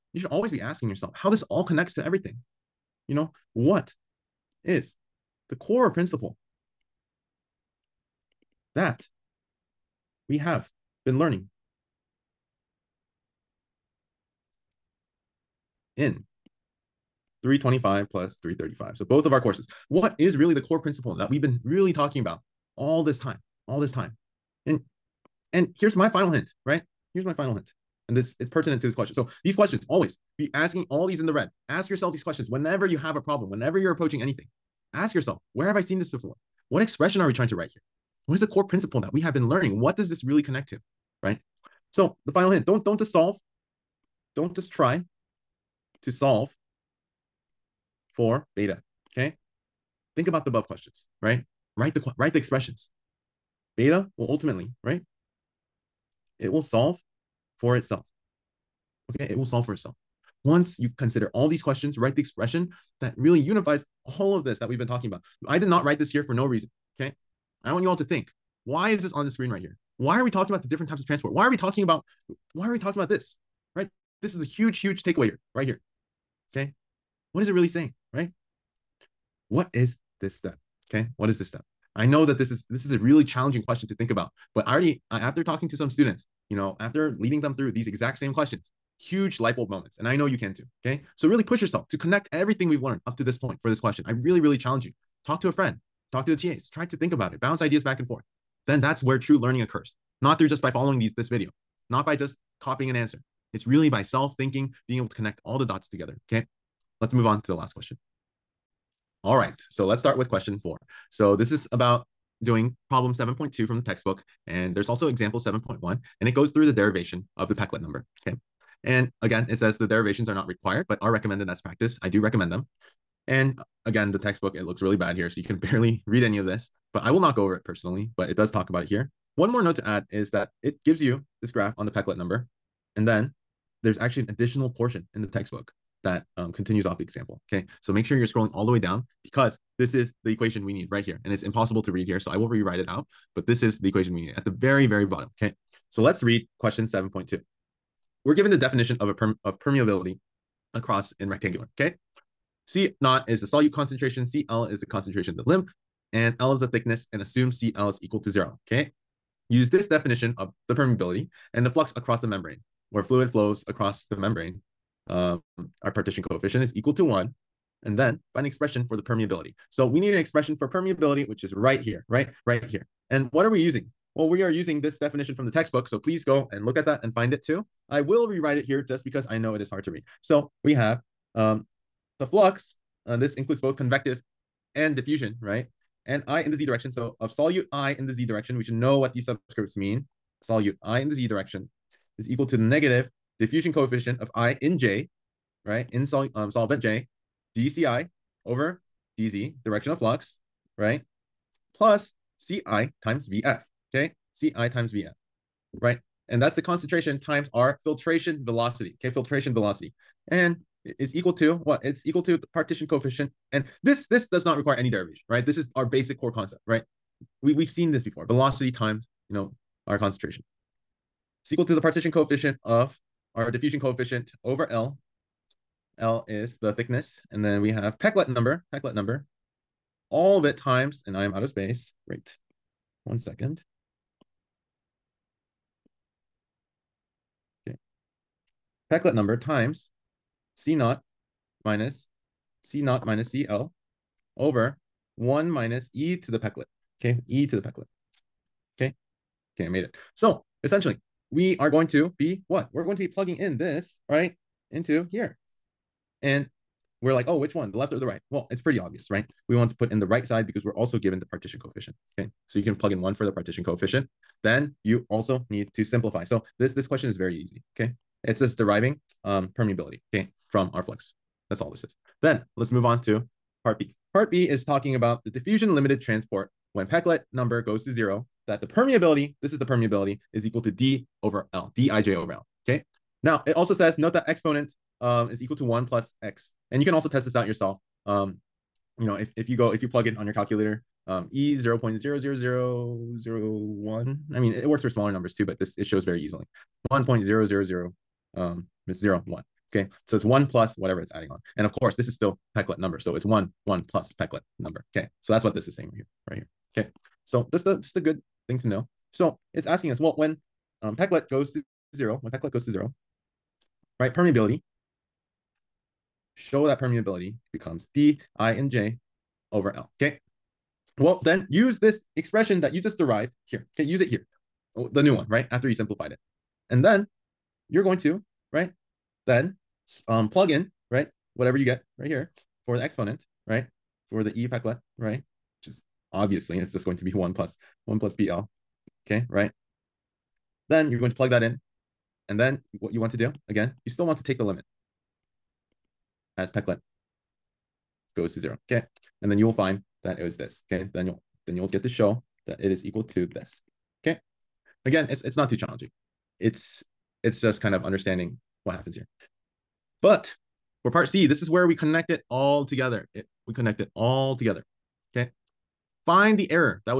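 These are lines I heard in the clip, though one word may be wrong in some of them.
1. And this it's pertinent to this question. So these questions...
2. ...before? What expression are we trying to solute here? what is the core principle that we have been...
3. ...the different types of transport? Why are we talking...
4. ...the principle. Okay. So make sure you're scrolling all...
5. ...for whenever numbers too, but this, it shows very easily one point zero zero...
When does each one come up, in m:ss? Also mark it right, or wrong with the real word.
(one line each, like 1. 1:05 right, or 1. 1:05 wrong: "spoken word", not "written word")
1. 0:28 right
2. 0:36 wrong: "write", not "solute"
3. 1:10 right
4. 2:16 wrong: "example", not "principle"
5. 4:54 wrong: "smaller", not "whenever".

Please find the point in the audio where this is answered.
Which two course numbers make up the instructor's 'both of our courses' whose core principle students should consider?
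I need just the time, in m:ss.
0:17.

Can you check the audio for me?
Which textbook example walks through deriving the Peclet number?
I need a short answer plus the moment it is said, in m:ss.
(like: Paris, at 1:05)
Example 7.1, at 1:55.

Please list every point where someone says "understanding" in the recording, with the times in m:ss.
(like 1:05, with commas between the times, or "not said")
5:57.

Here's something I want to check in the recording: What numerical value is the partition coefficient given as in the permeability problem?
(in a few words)
1.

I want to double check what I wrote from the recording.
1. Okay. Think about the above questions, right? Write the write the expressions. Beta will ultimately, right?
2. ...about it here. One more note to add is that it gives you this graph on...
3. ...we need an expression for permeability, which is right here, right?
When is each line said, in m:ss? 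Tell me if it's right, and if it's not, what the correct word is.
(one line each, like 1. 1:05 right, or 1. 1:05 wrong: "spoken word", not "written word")
1. 0:49 right
2. 2:08 right
3. 2:49 right.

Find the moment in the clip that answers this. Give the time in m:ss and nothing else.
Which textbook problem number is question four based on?
1:52.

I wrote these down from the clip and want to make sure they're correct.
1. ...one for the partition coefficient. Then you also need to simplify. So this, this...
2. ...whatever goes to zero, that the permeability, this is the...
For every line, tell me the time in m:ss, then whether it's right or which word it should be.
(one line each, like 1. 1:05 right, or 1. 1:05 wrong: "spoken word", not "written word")
1. 4:23 right
2. 4:37 wrong: "number", not "whatever".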